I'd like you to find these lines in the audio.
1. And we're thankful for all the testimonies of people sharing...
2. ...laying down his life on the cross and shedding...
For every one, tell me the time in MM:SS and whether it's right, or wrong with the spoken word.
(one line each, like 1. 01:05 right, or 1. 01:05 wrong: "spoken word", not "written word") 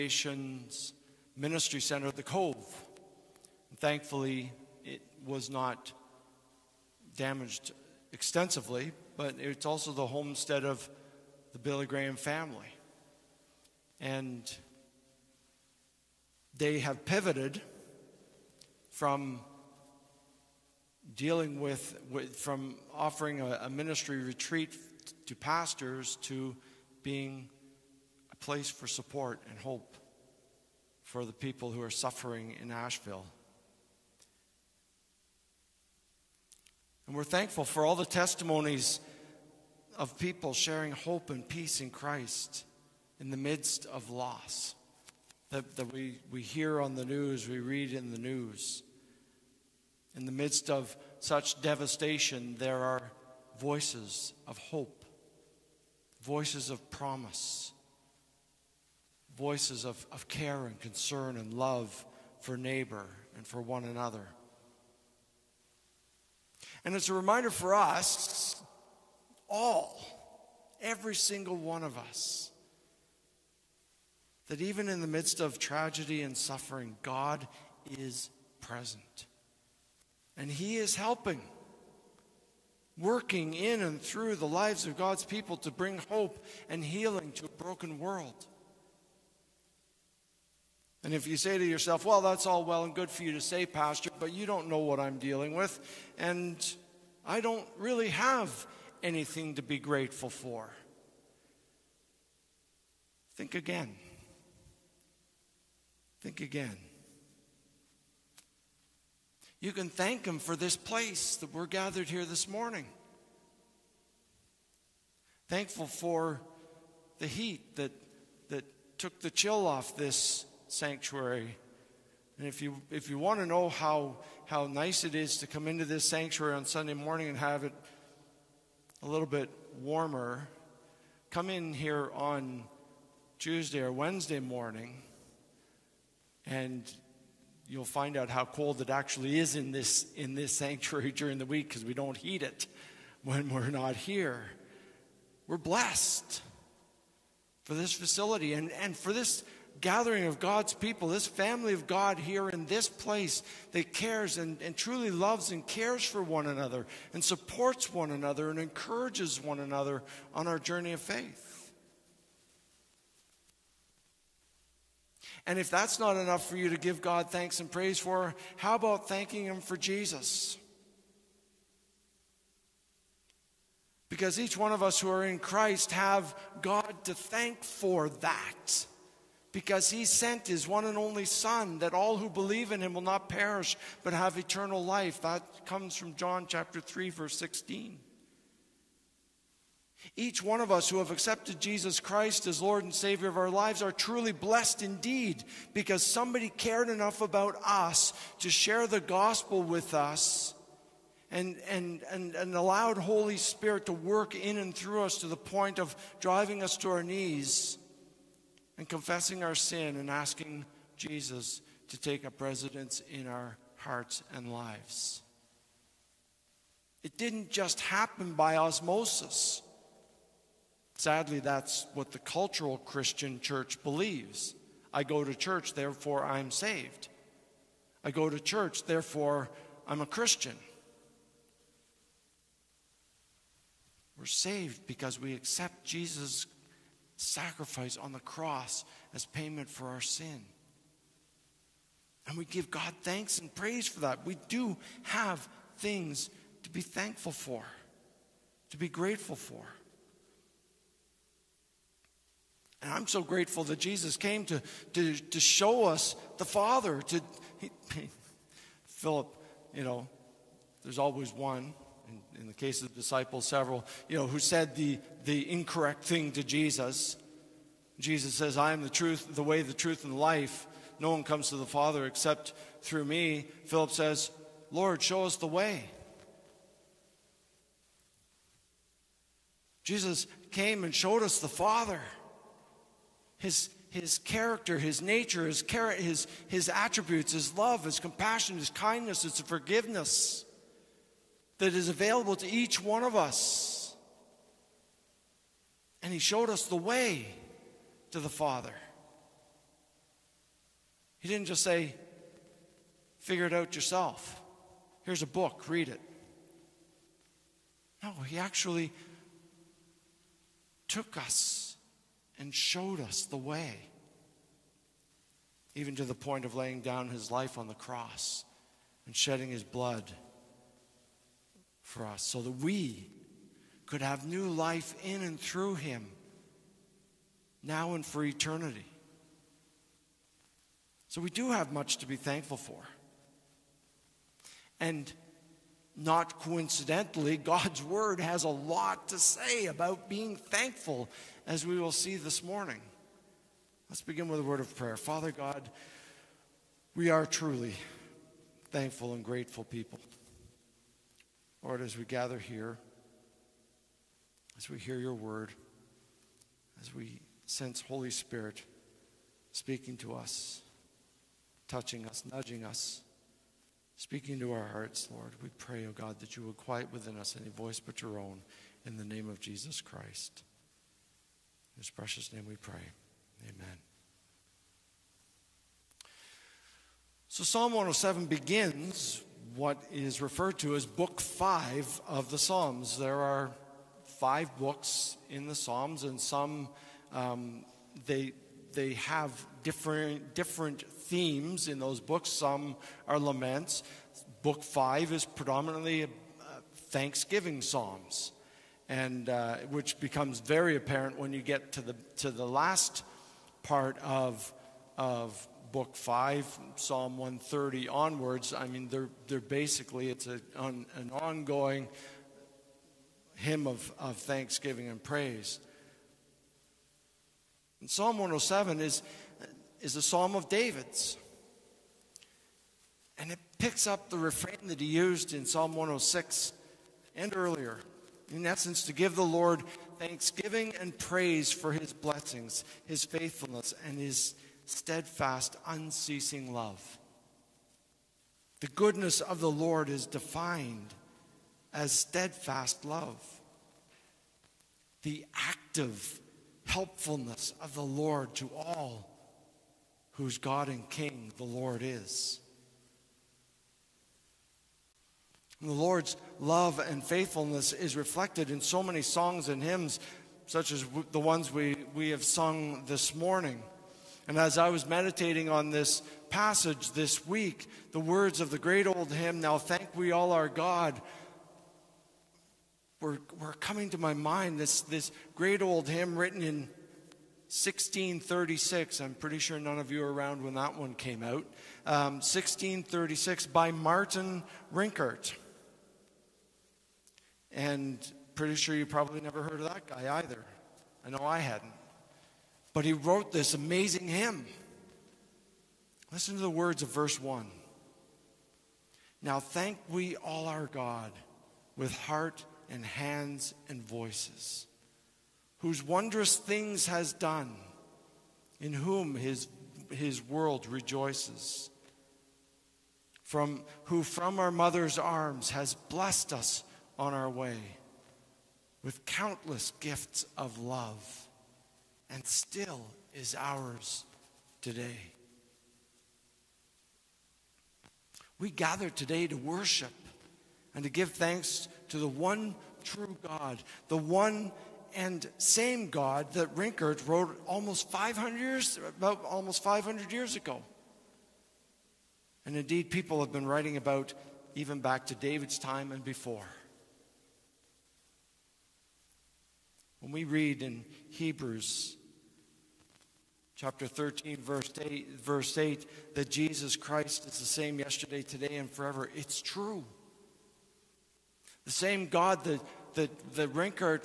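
1. 00:37 right
2. 05:16 right.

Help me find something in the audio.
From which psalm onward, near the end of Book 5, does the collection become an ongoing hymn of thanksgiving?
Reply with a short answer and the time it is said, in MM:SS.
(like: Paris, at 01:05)
Psalm 130, at 06:46.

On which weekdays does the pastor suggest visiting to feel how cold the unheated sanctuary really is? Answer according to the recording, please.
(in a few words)
Tuesday or Wednesday.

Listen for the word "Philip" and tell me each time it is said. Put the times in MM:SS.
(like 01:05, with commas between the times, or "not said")
04:18, 04:33.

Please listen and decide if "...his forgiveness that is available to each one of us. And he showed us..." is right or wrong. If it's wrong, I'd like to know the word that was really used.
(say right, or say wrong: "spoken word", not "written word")
right.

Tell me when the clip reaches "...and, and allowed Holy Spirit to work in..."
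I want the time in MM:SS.
03:22.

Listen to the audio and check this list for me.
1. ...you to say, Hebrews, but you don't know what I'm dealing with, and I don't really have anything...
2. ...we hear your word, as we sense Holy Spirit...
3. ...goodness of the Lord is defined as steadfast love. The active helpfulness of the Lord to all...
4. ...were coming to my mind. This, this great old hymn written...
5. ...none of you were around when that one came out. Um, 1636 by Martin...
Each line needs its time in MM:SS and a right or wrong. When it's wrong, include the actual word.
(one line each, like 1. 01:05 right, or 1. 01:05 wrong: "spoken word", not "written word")
1. 01:33 wrong: "Pastor", not "Hebrews"
2. 05:54 right
3. 07:18 right
4. 07:53 right
5. 07:59 right.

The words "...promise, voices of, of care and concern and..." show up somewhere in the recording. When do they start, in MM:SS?
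00:56.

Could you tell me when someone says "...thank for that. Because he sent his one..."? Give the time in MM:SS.
02:57.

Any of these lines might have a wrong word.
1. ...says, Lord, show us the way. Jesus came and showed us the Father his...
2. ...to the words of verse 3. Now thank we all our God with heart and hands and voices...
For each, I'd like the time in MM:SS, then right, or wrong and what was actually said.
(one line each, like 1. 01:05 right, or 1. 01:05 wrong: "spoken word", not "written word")
1. 04:33 right
2. 08:16 wrong: "1", not "3".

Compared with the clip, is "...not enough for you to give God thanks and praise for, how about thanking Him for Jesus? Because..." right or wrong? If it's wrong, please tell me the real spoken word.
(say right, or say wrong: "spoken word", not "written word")
right.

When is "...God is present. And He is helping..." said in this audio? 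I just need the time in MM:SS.
01:17.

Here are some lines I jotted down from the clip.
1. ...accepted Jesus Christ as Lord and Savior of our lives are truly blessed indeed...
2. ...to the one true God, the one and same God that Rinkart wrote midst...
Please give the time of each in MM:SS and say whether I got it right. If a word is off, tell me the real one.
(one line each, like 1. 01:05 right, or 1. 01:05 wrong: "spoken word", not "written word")
1. 03:11 right
2. 08:51 wrong: "almost", not "midst".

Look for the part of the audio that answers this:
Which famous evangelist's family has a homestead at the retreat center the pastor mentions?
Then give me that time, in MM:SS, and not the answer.
00:11.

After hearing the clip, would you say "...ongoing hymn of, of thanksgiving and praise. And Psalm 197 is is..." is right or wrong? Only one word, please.
wrong.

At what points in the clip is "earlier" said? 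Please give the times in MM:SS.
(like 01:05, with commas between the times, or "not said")
07:07.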